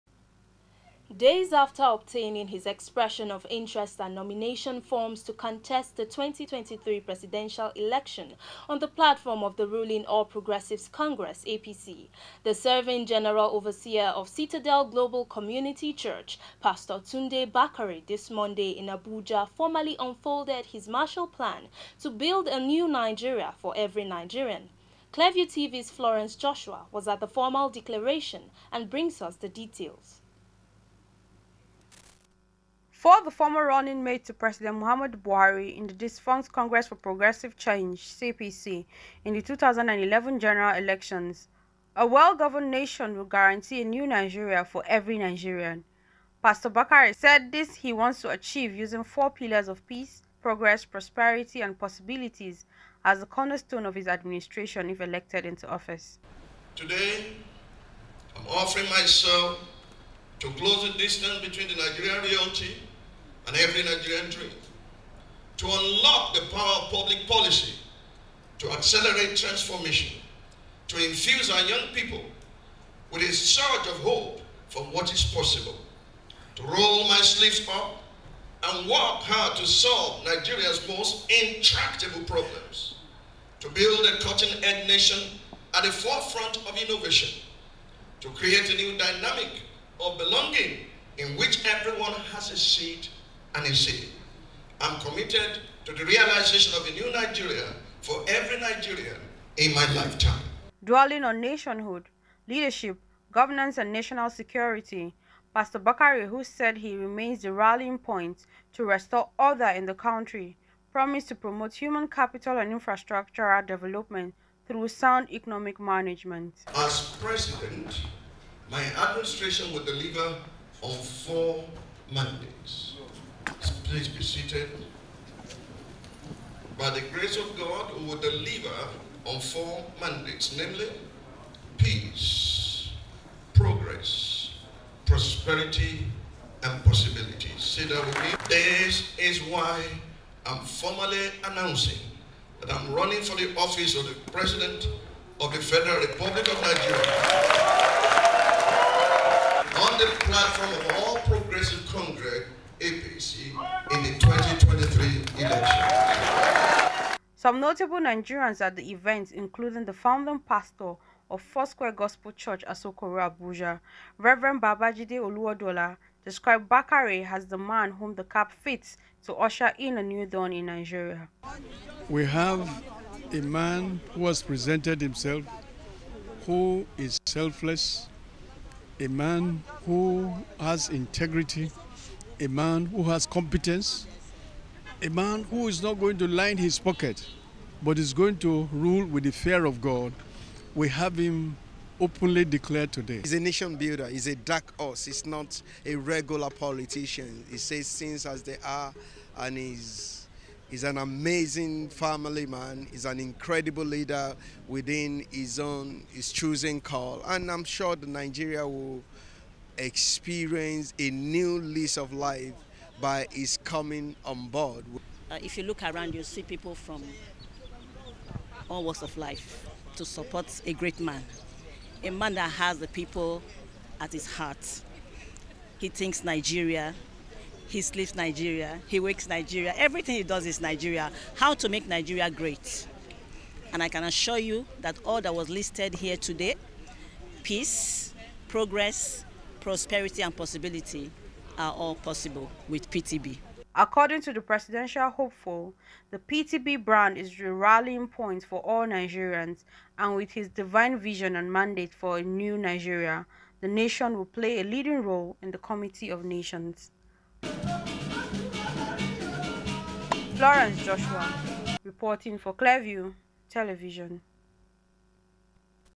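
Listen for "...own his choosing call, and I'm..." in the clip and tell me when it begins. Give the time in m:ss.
3:25.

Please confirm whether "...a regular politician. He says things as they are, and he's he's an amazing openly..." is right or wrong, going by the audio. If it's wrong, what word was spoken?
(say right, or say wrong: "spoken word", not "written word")
wrong: "family", not "openly".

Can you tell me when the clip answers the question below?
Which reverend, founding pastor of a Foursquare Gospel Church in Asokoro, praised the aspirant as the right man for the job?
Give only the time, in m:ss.
2:44.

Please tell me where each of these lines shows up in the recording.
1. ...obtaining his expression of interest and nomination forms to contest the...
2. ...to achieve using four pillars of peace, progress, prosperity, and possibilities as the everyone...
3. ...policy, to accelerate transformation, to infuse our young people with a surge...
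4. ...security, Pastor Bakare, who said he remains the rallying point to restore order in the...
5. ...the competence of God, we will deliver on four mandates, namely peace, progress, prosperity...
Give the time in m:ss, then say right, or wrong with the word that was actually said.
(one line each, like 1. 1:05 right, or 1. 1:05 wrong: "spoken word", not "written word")
1. 0:01 right
2. 0:48 wrong: "cornerstone", not "everyone"
3. 1:07 right
4. 1:44 right
5. 2:06 wrong: "grace", not "competence".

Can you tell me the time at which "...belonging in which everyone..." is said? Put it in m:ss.
1:30.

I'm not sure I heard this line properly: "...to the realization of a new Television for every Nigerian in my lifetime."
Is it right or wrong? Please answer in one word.
wrong.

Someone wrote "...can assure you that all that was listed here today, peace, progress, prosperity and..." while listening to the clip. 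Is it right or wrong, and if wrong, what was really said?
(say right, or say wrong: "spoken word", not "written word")
right.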